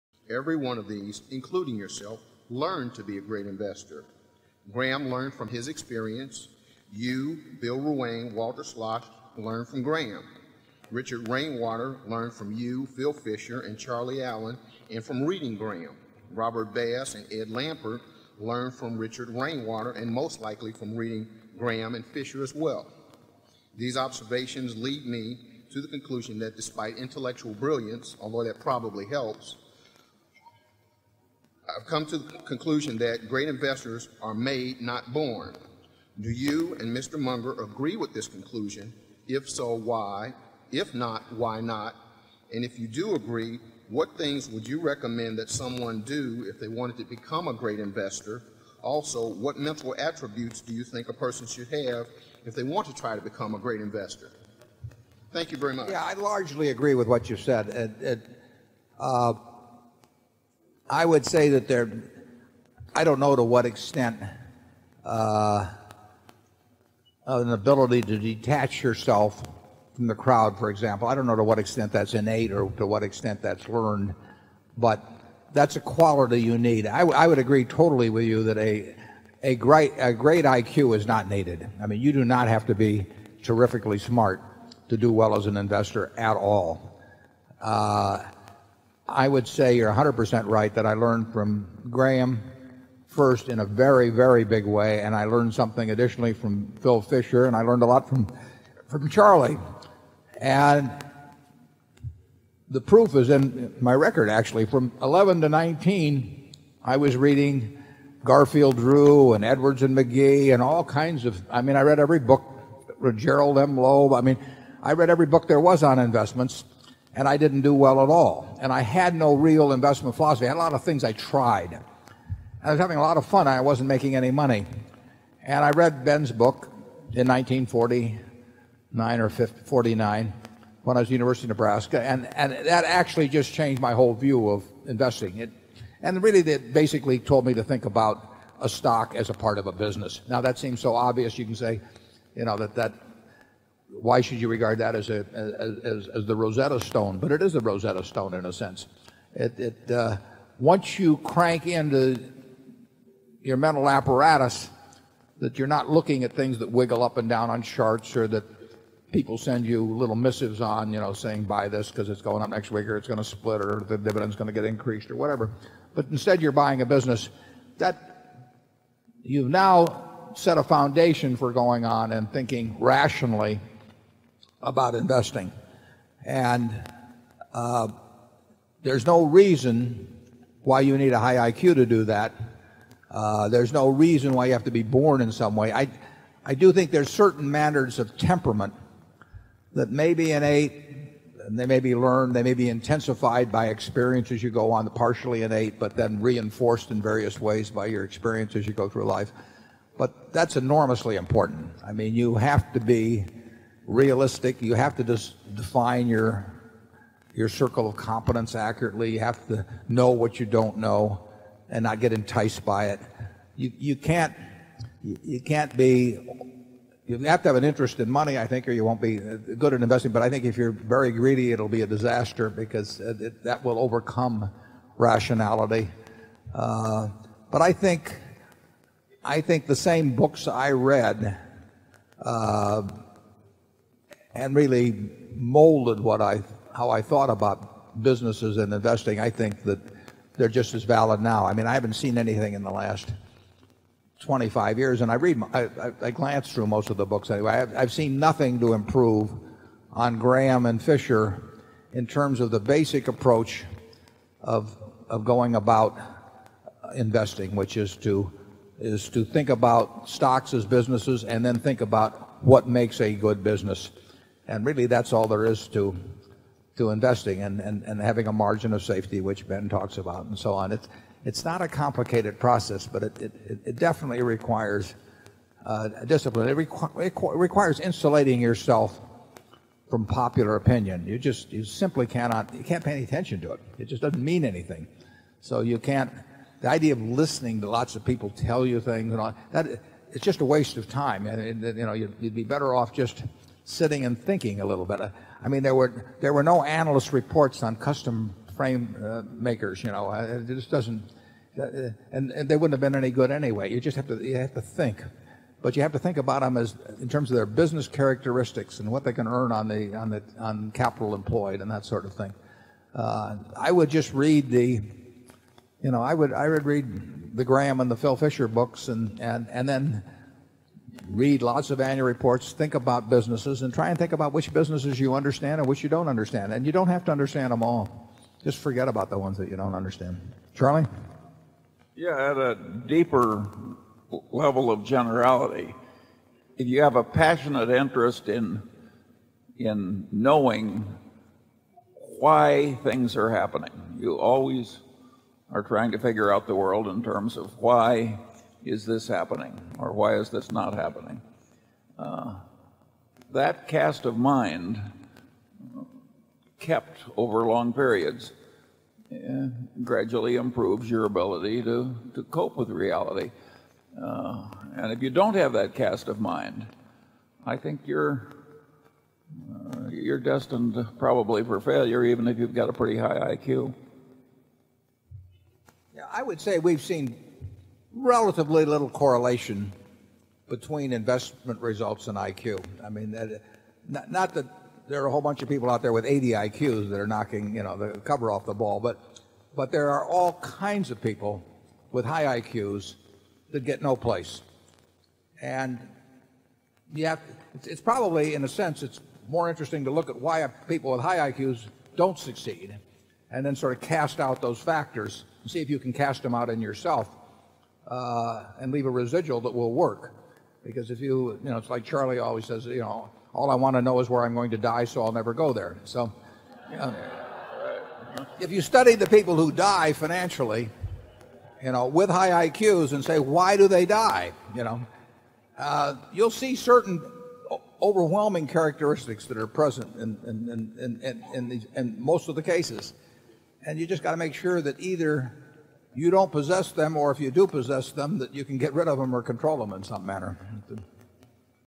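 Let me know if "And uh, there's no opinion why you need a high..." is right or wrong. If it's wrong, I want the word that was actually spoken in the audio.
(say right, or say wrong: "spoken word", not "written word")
wrong: "reason", not "opinion".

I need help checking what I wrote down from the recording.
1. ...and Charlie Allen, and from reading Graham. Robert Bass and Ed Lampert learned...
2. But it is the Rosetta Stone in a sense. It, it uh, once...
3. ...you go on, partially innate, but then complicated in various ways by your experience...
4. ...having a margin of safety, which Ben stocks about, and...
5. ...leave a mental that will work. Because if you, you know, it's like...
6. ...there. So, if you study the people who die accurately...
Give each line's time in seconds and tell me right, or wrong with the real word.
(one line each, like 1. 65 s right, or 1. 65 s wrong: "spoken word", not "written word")
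1. 13 s right
2. 147 s right
3. 194 s wrong: "reinforced", not "complicated"
4. 267 s wrong: "talks", not "stocks"
5. 408 s wrong: "residual", not "mental"
6. 415 s wrong: "financially", not "accurately".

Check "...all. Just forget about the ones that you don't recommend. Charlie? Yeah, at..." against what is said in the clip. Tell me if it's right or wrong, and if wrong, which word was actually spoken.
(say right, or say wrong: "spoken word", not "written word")
wrong: "understand", not "recommend".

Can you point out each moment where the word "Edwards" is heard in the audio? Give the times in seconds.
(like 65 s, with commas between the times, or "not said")
109 s.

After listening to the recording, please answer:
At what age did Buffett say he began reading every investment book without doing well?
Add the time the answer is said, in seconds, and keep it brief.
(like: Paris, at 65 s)
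11, at 105 s.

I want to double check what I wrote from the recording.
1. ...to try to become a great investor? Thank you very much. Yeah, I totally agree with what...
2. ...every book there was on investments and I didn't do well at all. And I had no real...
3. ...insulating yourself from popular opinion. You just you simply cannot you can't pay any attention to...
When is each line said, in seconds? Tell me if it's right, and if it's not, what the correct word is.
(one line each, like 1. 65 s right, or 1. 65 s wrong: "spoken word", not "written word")
1. 52 s wrong: "largely", not "totally"
2. 115 s right
3. 277 s right.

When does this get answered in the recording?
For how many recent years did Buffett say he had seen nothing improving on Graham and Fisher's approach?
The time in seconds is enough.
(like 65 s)
244 s.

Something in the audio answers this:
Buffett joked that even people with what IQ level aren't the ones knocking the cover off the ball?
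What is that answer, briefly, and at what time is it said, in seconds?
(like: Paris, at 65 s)
80, at 386 s.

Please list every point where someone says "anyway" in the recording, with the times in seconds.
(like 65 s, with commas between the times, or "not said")
247 s, 303 s.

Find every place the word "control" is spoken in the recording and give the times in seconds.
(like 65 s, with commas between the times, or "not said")
439 s.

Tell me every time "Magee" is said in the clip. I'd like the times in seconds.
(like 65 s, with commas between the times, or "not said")
109 s.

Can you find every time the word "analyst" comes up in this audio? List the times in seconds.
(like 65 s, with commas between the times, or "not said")
296 s.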